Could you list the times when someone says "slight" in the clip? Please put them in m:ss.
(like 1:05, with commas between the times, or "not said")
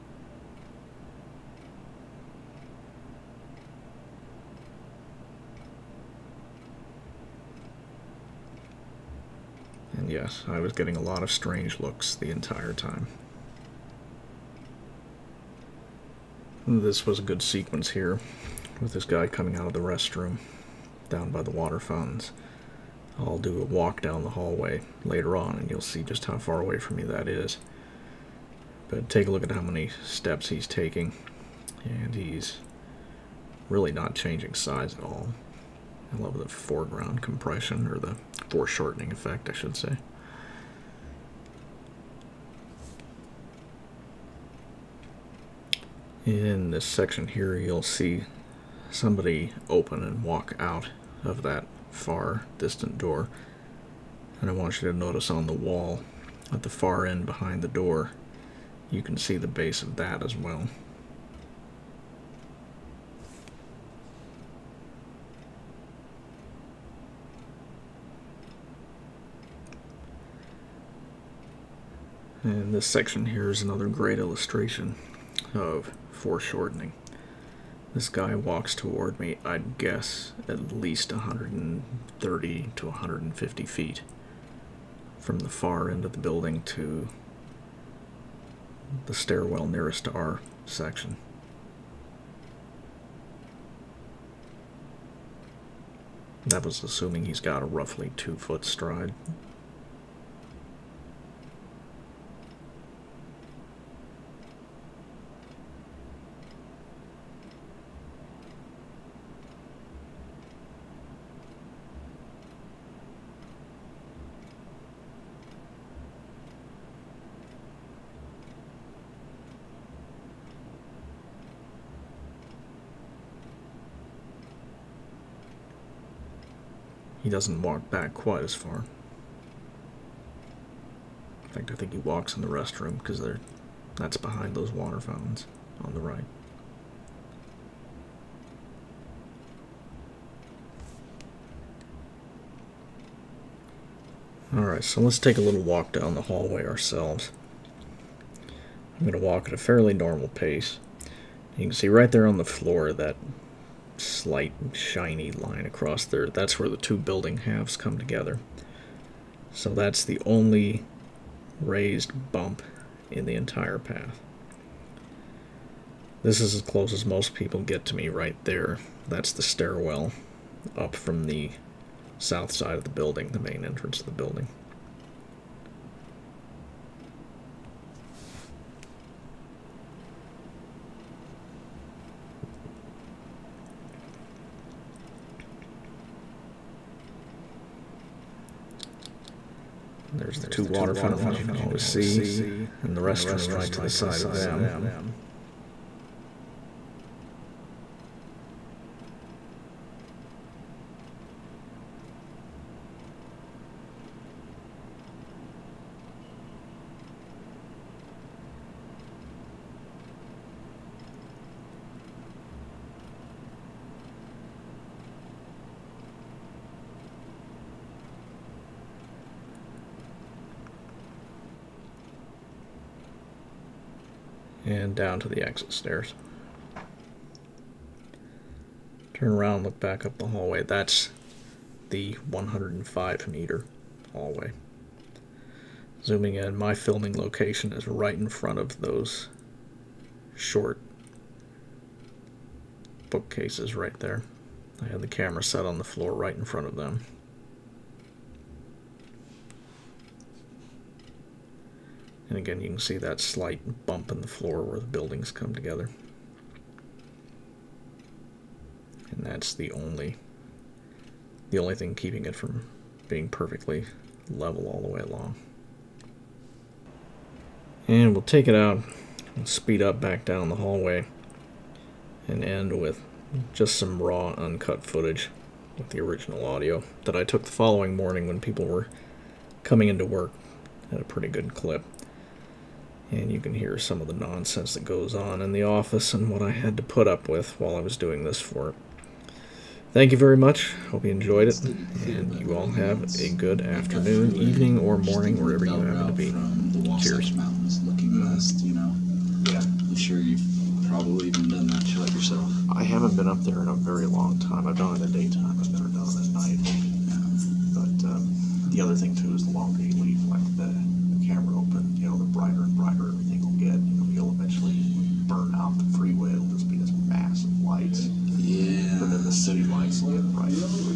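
2:33, 4:13.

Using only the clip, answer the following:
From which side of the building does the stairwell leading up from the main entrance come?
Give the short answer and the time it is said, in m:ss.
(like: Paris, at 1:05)
south side, at 2:52.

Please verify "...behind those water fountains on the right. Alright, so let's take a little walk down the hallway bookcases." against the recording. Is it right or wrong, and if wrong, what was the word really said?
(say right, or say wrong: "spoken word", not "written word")
wrong: "ourselves", not "bookcases".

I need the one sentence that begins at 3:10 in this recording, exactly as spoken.
There's the two water fountains you can always see, and the restroom right to the side of them.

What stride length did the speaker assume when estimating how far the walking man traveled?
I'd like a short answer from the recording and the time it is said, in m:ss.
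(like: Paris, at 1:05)
two foot, at 1:38.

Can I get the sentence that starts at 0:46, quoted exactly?
In this section here, you'll see somebody open and walk out of that far distant door.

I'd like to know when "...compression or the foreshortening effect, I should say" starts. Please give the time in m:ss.
0:37.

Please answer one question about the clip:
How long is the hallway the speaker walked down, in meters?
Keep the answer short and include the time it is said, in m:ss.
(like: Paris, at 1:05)
105 meters, at 3:52.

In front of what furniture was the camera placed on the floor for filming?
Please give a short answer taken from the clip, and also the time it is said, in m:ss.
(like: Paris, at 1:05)
short bookcases, at 4:00.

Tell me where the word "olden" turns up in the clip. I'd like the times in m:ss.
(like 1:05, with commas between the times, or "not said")
not said.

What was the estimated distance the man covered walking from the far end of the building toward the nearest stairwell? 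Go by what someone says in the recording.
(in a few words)
130 to 150 feet.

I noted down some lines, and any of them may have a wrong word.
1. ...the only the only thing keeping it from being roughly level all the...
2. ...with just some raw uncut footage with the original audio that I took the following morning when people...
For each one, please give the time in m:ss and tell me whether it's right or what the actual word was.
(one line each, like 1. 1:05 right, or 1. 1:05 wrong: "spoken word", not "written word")
1. 4:19 wrong: "perfectly", not "roughly"
2. 4:32 right.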